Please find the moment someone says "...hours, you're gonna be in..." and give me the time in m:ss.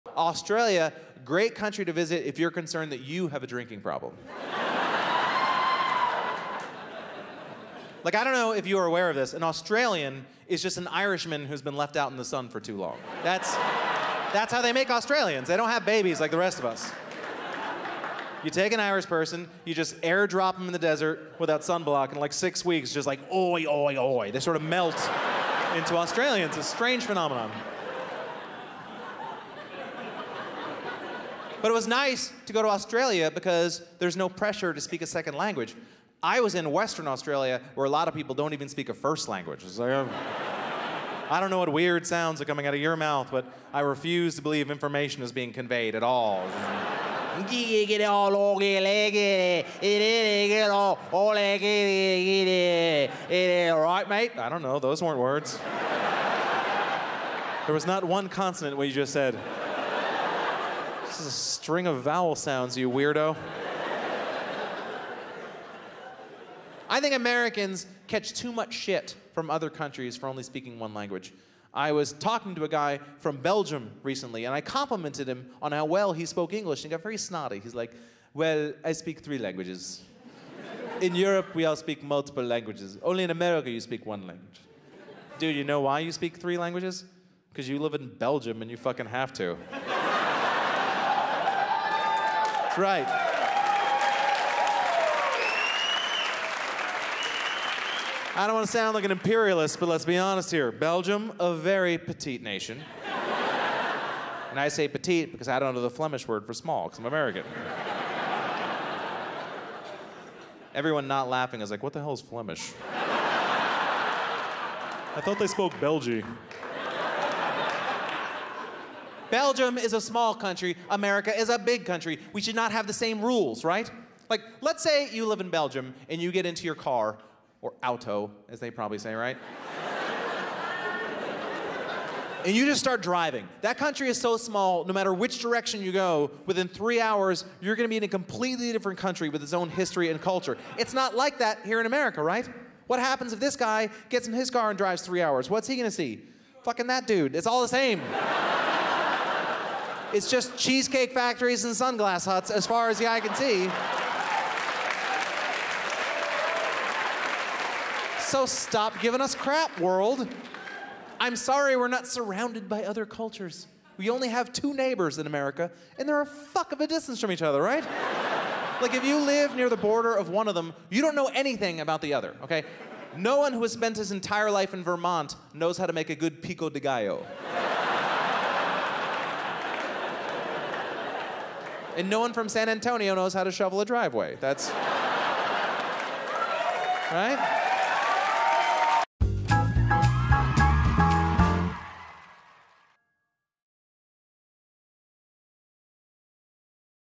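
2:16.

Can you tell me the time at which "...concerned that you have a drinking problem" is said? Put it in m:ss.
0:02.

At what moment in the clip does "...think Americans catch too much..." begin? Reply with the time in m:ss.
1:07.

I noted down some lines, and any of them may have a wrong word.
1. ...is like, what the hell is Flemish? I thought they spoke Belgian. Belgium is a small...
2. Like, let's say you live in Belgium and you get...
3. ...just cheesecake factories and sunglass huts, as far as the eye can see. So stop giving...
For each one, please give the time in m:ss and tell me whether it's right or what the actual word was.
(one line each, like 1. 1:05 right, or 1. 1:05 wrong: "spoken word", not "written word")
1. 1:51 right
2. 2:04 right
3. 2:30 right.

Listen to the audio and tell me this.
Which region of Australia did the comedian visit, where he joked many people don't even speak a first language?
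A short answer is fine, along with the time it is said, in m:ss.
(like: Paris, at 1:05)
Western Australia, at 0:36.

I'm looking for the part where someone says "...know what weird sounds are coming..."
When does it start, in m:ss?
0:41.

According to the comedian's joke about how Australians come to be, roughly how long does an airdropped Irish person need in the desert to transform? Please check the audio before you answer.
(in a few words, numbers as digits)
6 weeks.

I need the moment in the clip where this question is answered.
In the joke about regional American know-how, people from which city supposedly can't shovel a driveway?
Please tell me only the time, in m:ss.
3:02.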